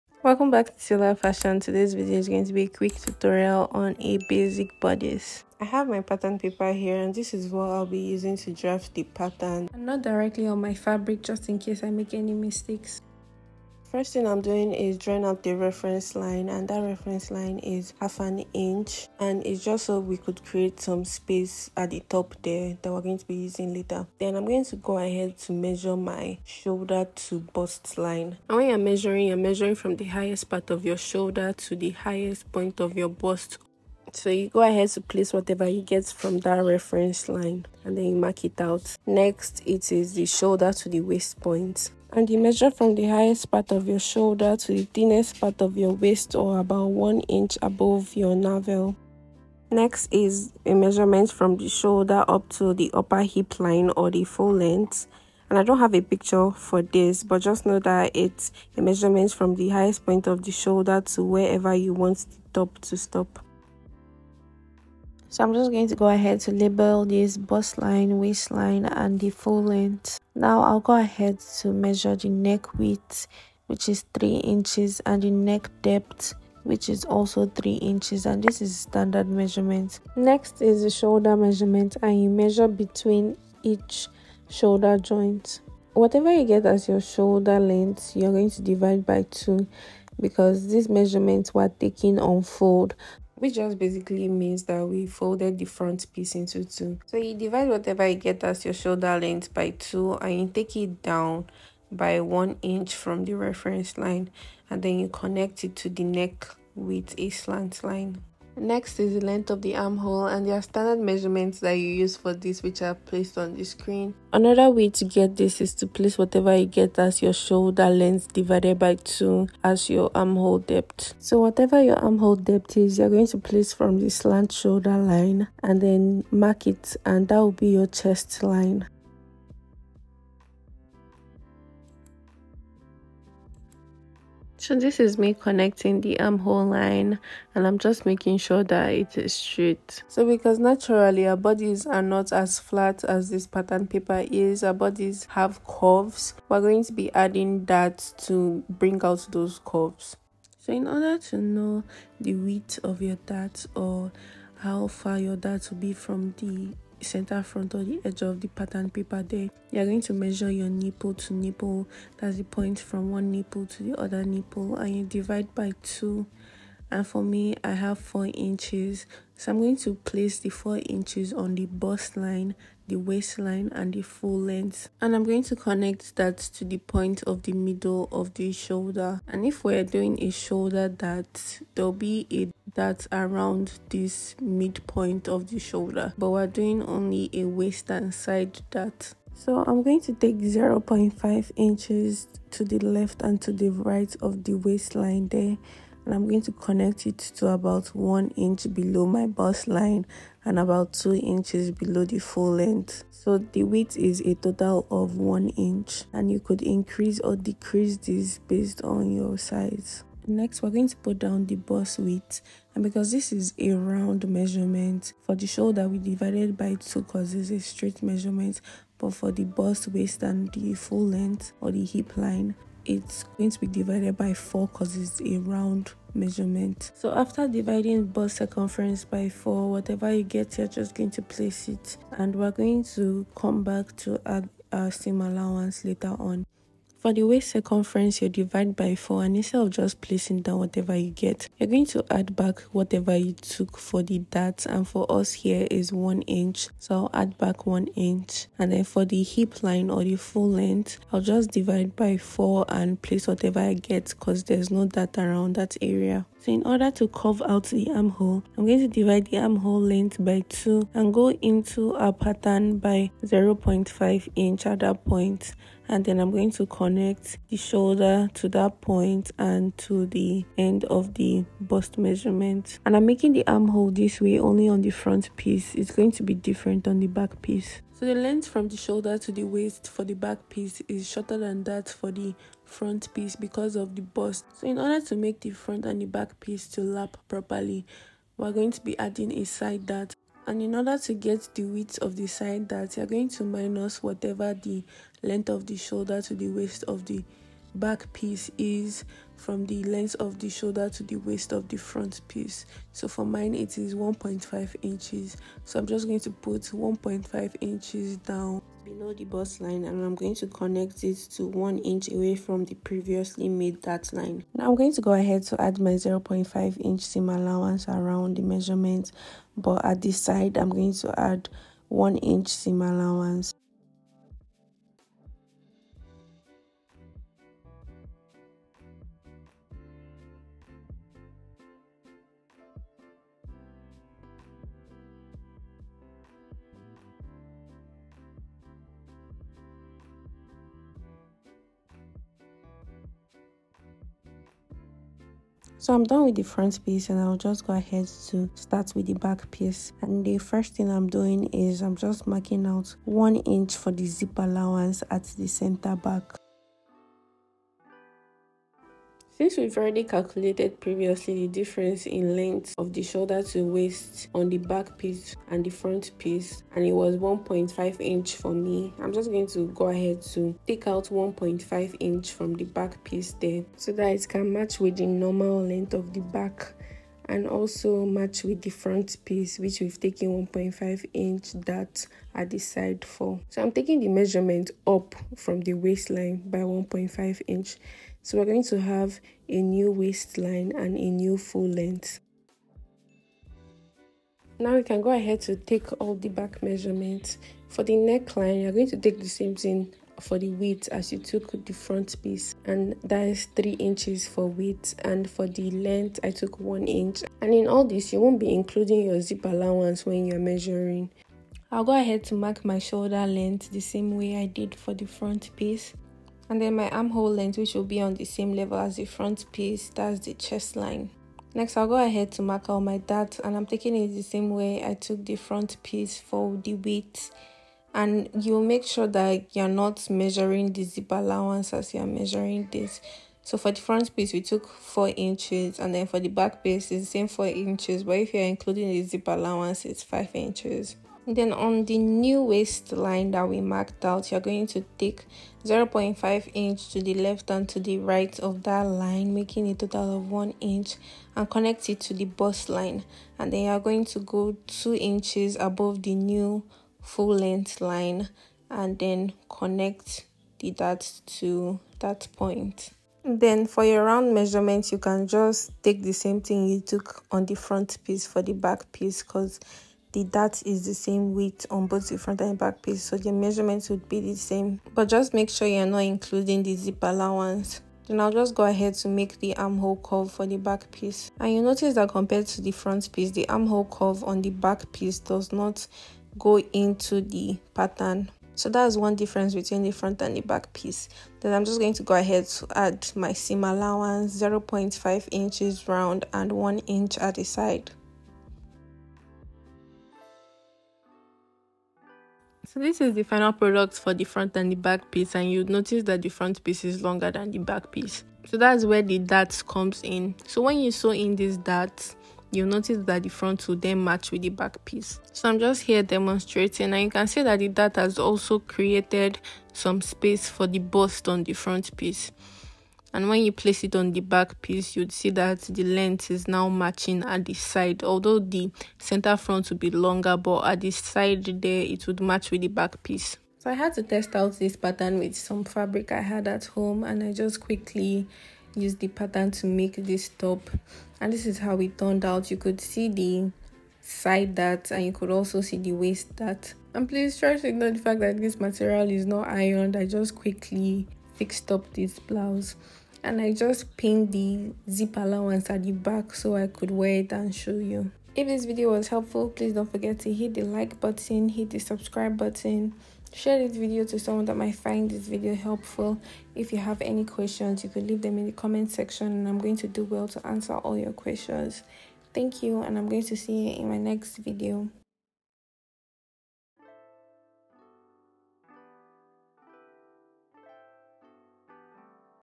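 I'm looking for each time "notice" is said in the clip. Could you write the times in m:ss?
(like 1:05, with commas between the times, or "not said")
8:01, 8:25, 8:32.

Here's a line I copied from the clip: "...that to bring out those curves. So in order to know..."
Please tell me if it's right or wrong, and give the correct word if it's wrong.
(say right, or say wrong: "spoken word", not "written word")
right.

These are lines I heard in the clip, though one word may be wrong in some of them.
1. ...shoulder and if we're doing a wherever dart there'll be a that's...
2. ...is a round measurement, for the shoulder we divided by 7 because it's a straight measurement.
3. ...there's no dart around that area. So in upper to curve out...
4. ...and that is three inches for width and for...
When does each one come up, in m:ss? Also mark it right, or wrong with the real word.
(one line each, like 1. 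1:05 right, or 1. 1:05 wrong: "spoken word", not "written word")
1. 2:58 wrong: "shoulder", not "wherever"
2. 3:33 wrong: "2", not "7"
3. 4:14 wrong: "order", not "upper"
4. 6:42 right.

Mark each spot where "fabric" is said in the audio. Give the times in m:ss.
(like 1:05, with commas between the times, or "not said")
0:10, 8:55.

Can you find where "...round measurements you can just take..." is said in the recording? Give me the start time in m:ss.
7:44.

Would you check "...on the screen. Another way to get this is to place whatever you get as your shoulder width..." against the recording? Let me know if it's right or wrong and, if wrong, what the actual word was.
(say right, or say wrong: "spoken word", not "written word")
wrong: "length", not "width".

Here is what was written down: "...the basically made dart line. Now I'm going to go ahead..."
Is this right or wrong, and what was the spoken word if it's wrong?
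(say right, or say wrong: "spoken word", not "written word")
wrong: "previously", not "basically".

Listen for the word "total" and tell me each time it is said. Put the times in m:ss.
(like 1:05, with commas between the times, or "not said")
3:24, 7:29.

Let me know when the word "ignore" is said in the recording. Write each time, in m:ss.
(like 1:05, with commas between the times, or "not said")
9:07.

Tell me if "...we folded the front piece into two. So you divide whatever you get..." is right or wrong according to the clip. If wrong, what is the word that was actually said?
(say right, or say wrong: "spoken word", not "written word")
right.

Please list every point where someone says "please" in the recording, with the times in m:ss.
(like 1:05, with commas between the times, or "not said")
9:07, 9:19.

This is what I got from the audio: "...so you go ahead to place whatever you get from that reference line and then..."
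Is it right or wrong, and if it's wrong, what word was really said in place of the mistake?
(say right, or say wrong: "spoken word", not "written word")
right.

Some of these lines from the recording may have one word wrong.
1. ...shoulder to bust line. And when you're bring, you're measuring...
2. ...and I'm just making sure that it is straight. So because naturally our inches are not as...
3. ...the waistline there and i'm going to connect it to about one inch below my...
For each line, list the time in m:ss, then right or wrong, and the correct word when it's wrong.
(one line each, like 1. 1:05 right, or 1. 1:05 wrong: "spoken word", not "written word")
1. 0:26 wrong: "measuring", not "bring"
2. 2:17 wrong: "bodies", not "inches"
3. 3:14 right.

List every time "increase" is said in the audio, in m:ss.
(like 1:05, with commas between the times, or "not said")
3:26.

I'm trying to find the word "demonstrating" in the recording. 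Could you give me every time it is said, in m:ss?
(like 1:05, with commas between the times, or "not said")
8:36.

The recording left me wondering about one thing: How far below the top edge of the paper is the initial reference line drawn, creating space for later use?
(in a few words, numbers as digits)
half an inch.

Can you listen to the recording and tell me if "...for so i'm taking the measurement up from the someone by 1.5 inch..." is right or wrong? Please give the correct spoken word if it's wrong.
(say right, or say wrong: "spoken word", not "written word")
wrong: "waistline", not "someone".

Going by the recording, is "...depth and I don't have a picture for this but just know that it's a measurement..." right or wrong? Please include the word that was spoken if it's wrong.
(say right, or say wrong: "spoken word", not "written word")
wrong: "length", not "depth".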